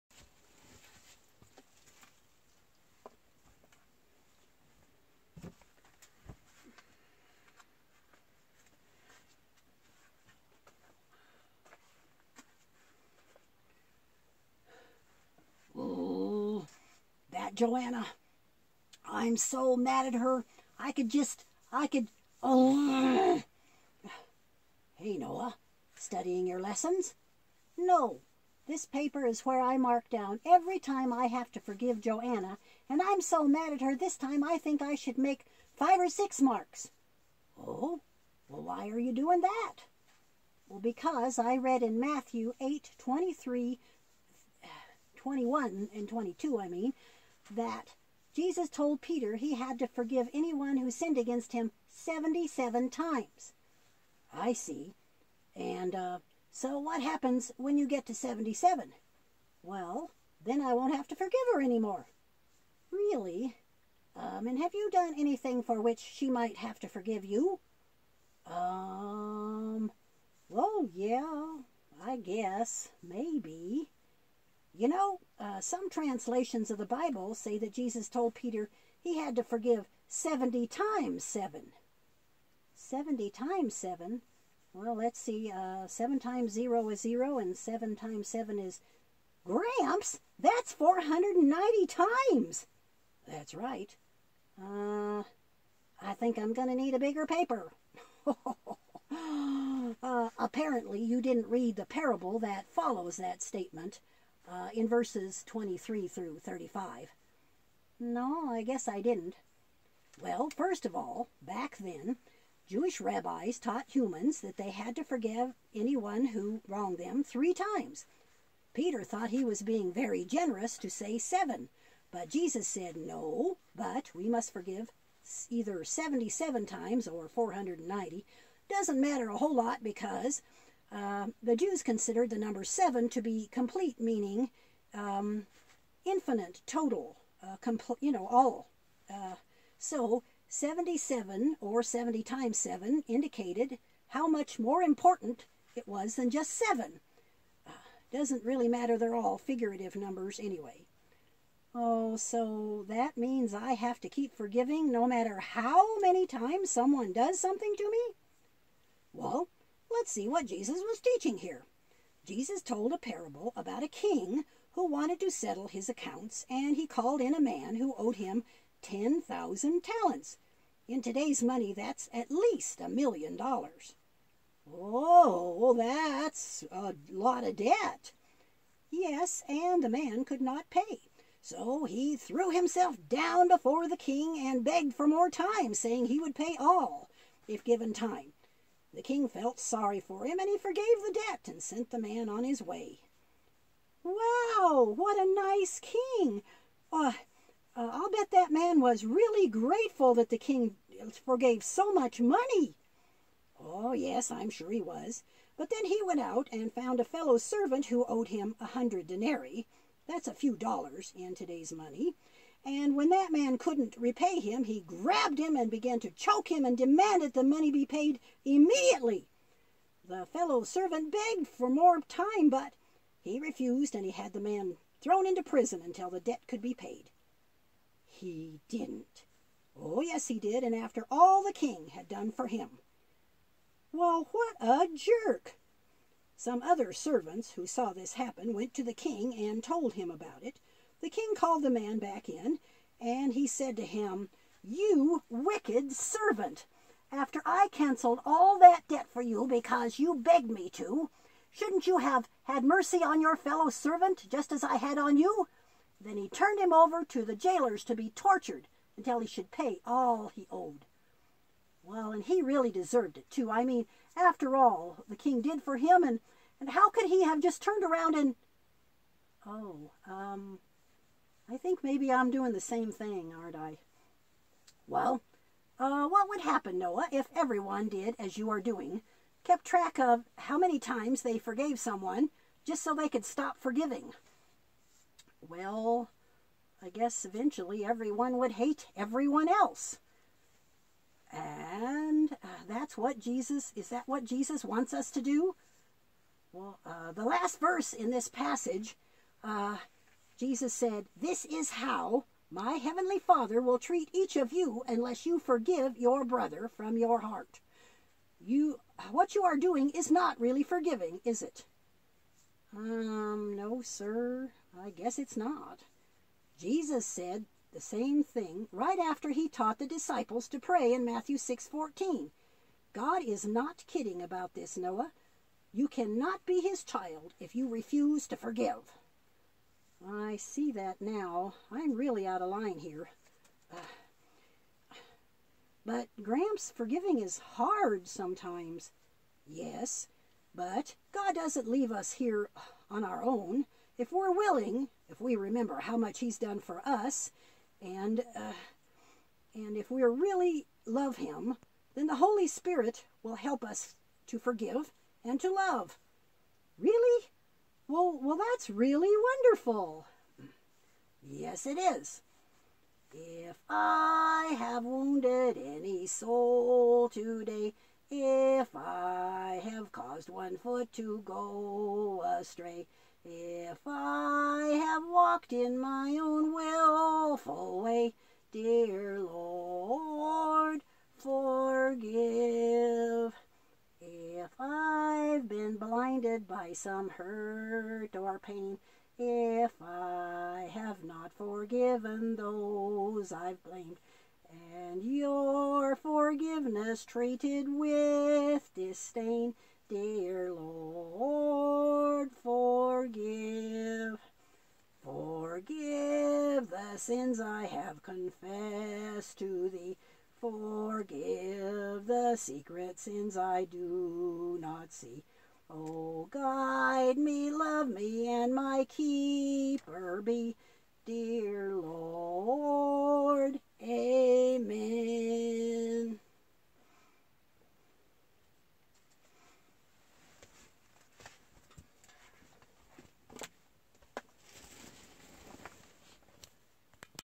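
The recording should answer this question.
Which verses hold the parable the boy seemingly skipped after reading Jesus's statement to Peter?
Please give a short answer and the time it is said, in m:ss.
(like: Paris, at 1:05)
23 through 35, at 1:45.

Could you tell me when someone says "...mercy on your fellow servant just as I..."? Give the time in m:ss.
4:12.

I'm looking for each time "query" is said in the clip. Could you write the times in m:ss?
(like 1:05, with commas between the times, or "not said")
not said.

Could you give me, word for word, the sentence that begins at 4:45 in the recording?
Well, I guess eventually everyone would hate everyone else.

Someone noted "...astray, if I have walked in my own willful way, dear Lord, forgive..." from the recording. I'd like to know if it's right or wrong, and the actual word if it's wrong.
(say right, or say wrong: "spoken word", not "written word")
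right.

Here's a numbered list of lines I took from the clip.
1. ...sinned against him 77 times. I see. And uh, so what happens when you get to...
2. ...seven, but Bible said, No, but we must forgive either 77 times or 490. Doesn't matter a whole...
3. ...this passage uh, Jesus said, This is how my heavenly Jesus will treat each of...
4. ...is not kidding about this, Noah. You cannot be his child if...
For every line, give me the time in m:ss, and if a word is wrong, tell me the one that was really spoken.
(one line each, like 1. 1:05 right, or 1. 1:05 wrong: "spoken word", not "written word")
1. 0:50 right
2. 2:01 wrong: "Jesus", not "Bible"
3. 4:58 wrong: "Father", not "Jesus"
4. 5:23 right.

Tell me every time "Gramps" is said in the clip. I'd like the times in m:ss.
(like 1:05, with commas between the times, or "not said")
1:29, 5:36.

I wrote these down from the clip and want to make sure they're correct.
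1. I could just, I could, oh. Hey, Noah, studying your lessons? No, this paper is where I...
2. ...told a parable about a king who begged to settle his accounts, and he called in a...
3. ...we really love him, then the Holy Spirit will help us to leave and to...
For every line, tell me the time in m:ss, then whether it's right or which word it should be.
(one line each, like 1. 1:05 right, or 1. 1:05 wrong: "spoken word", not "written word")
1. 0:20 right
2. 2:42 wrong: "wanted", not "begged"
3. 5:49 wrong: "forgive", not "leave".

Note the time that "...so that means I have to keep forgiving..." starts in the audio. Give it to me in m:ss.
2:32.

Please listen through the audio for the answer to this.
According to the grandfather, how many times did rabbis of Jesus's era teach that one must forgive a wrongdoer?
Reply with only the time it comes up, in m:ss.
1:57.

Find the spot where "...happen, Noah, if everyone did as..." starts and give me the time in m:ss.
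4:36.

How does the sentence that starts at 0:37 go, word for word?
Oh, well, why are you doing that?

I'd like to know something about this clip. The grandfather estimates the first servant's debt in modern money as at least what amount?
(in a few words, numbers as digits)
a million dollars.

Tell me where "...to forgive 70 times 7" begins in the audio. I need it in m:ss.
1:19.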